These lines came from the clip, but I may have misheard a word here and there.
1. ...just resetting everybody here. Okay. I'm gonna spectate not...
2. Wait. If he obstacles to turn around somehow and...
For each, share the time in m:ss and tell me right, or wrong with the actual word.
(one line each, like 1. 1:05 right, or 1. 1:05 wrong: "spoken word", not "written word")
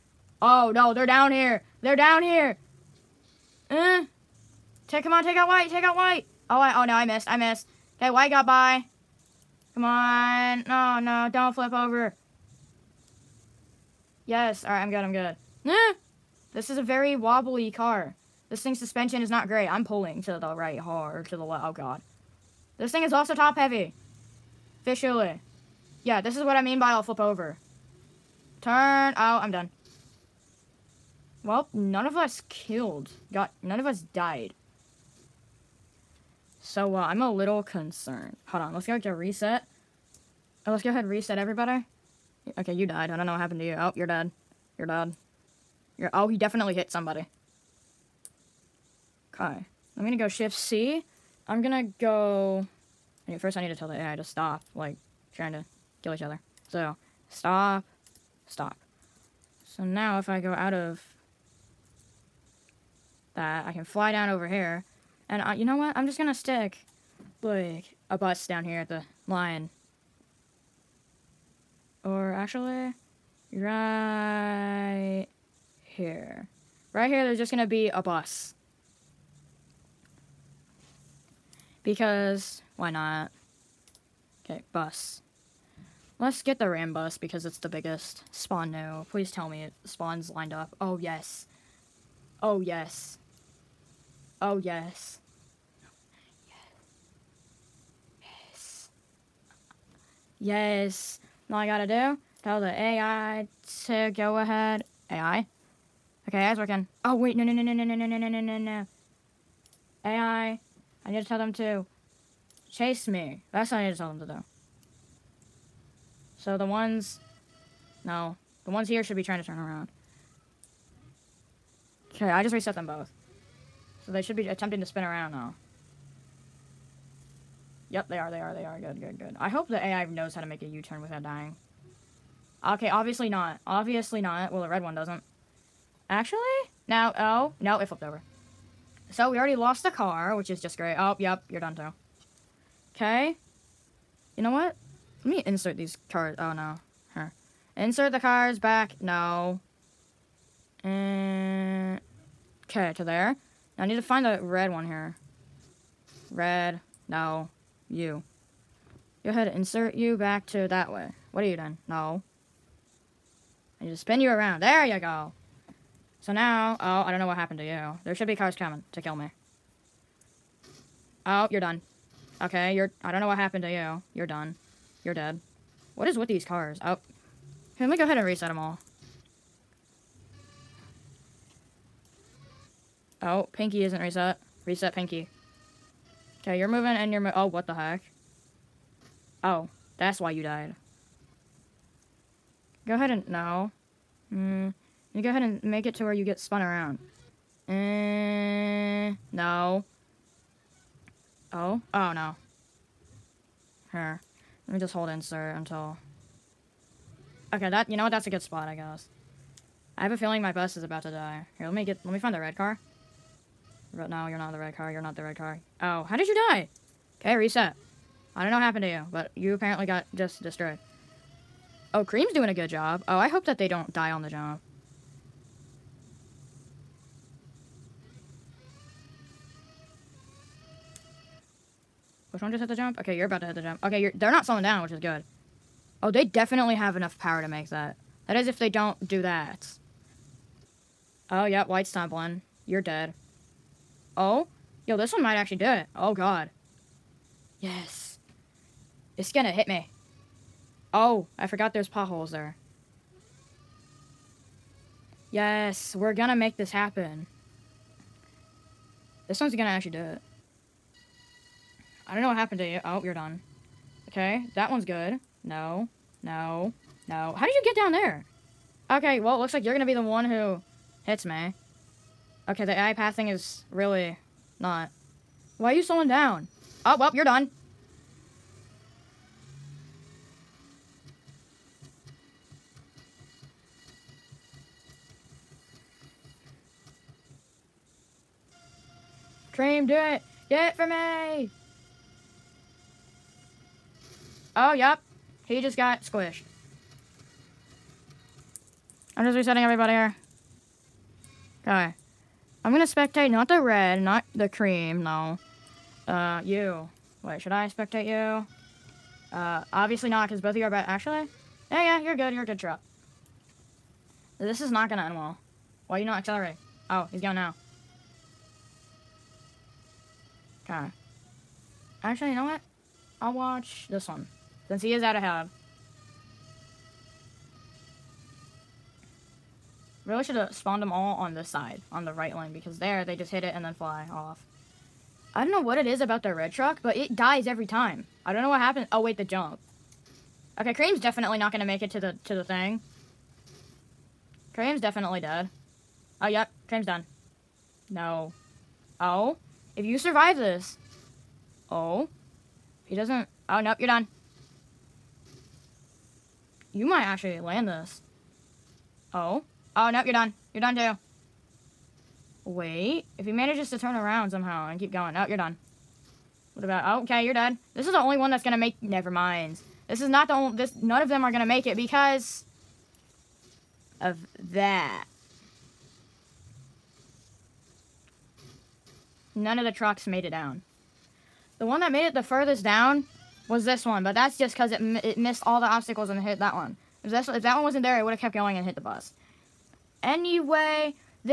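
1. 4:59 right
2. 6:02 wrong: "manages", not "obstacles".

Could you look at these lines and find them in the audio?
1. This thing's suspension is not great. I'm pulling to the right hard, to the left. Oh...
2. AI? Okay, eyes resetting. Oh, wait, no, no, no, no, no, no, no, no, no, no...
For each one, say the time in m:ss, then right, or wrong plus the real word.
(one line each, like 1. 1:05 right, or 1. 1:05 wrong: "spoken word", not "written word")
1. 0:18 right
2. 1:45 wrong: "working", not "resetting".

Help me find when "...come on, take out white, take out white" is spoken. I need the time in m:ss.
0:05.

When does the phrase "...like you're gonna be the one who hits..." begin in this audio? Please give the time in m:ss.
4:29.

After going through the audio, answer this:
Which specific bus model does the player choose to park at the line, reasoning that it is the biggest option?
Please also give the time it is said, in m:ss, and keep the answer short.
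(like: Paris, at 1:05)
Ram bus, at 1:26.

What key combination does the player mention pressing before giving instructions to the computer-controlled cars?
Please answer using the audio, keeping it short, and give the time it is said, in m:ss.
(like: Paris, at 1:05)
Shift C, at 0:50.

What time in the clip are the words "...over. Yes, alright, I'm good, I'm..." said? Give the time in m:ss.
0:11.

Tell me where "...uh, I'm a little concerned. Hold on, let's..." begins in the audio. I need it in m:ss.
0:36.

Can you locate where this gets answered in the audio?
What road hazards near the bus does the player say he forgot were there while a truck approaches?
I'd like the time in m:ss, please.
4:11.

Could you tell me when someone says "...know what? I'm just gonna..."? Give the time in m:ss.
1:05.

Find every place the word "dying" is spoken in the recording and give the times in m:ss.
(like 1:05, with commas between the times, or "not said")
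2:11.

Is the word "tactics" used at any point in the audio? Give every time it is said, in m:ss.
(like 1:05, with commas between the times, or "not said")
not said.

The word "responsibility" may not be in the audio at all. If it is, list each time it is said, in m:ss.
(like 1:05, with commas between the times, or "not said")
not said.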